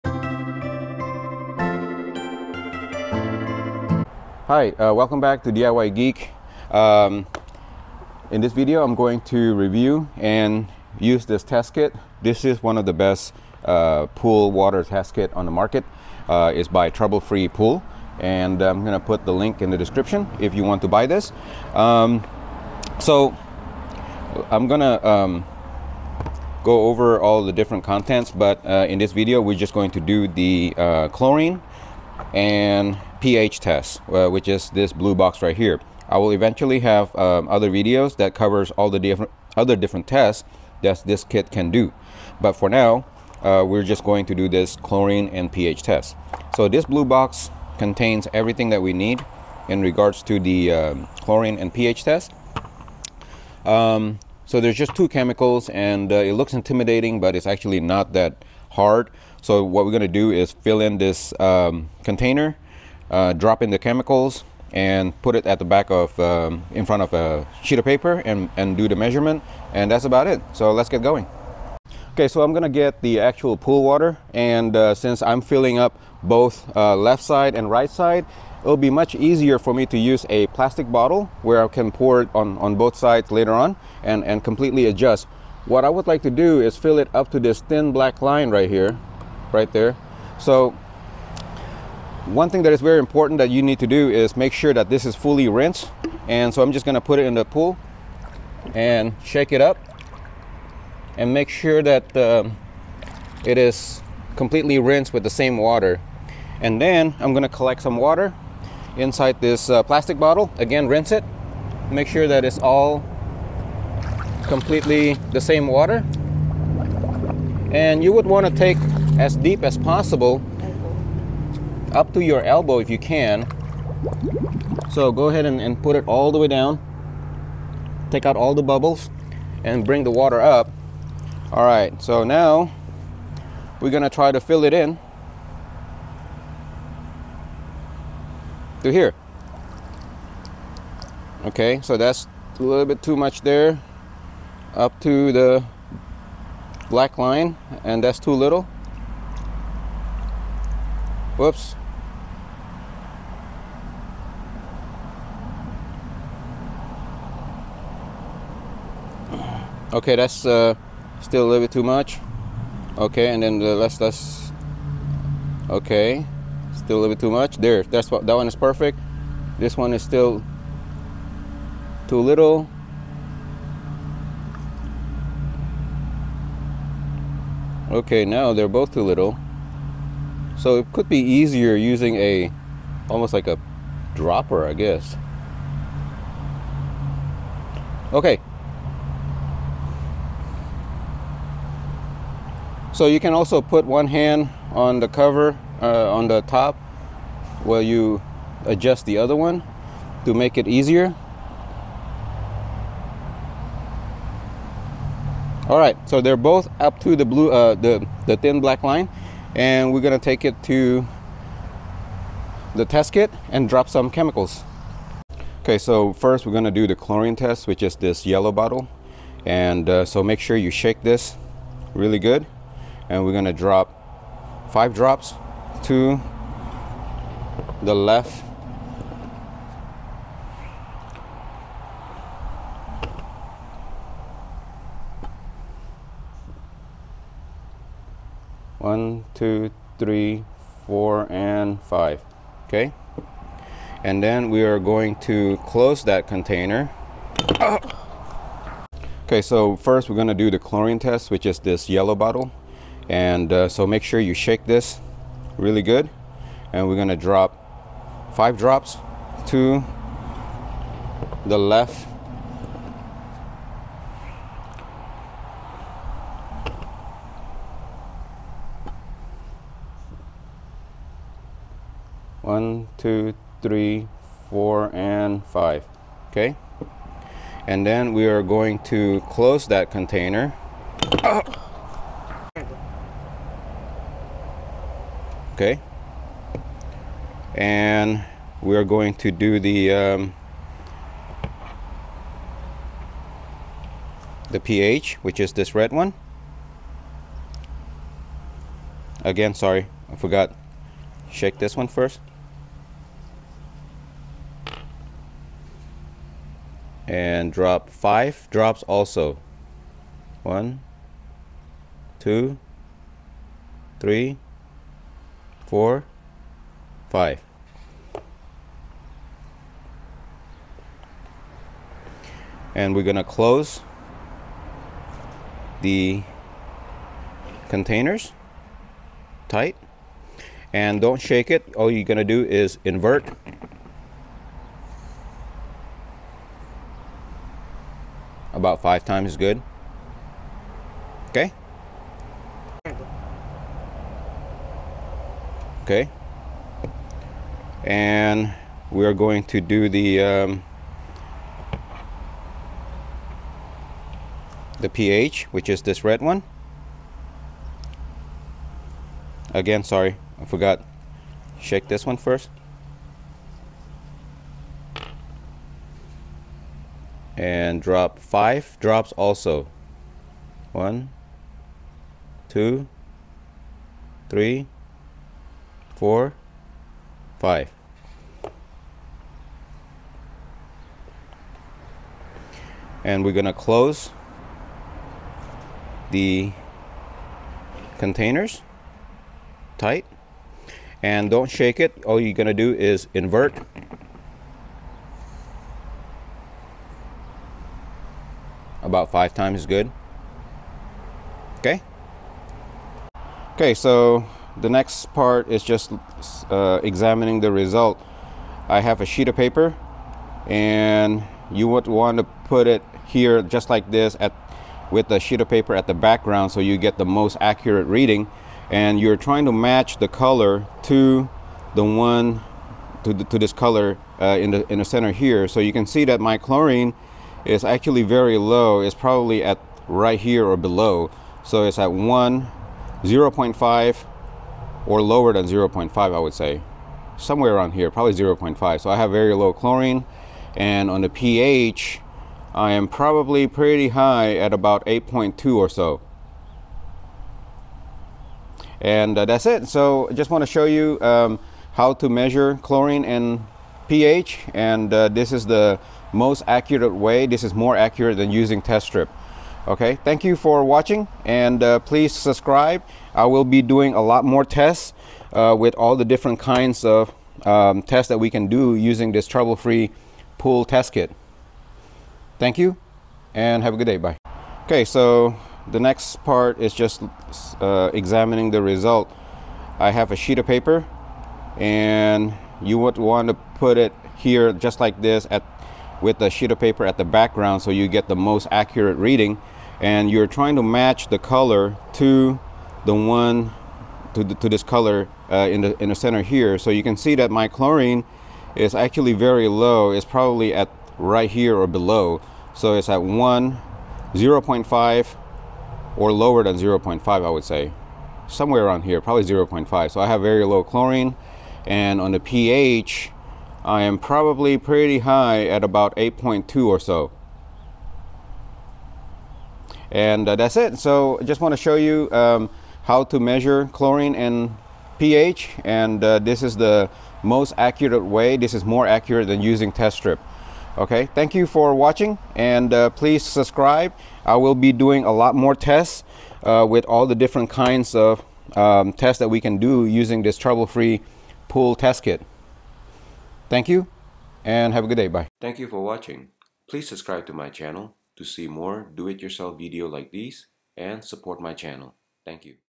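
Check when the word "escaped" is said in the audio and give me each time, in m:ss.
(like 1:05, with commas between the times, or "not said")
not said.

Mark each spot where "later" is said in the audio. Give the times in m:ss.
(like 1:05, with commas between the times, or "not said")
1:23.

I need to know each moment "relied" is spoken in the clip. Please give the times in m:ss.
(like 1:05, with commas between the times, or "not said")
not said.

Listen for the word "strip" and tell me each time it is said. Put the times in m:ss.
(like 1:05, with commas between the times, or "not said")
7:38, 8:49.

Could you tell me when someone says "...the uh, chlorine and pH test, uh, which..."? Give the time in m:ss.
0:30.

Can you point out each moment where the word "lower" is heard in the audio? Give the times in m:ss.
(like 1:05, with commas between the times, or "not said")
7:15, 8:26.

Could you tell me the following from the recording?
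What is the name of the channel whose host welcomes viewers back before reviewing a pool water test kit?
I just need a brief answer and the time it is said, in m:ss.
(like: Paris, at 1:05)
DIY Geek, at 0:05.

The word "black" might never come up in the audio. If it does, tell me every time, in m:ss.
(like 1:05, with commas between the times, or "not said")
1:27, 2:26, 3:28.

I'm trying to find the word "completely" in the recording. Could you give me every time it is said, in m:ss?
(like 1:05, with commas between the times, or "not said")
1:24, 1:44, 1:54.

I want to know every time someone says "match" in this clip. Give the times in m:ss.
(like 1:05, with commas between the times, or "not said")
6:59, 8:10.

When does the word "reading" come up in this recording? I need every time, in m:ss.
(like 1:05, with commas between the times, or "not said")
6:57, 8:08.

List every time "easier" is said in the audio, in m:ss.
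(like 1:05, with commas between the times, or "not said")
1:19, 3:01, 3:20.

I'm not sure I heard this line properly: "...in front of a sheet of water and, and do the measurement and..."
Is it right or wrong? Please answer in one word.
wrong.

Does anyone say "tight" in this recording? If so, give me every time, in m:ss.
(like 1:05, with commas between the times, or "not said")
5:29, 6:29.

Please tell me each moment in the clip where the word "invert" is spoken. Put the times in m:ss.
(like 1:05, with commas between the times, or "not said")
5:32, 6:33.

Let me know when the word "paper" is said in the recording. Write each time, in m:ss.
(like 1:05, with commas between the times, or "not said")
1:07, 6:49, 6:55, 8:00, 8:06.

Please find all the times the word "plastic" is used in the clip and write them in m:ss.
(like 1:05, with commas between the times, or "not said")
1:20, 1:49.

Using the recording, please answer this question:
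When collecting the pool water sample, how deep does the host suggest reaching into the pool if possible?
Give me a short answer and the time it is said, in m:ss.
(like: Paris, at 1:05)
Up to your elbow, at 2:01.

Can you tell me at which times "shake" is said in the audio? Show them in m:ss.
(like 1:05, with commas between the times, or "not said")
1:39, 3:40, 4:14, 5:01, 5:31, 6:01, 6:31.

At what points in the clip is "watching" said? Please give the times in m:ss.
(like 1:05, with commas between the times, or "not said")
7:40, 8:51, 9:05.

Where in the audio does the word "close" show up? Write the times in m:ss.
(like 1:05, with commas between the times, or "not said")
4:05, 4:39, 5:23, 6:23.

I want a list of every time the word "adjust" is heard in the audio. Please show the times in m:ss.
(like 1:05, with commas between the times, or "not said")
1:24, 3:18.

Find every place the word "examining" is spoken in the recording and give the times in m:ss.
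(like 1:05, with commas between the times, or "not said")
6:46, 7:57.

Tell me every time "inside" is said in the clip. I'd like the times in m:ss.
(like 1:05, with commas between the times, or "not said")
1:48.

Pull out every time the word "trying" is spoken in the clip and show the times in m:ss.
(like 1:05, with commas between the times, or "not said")
6:59, 8:10.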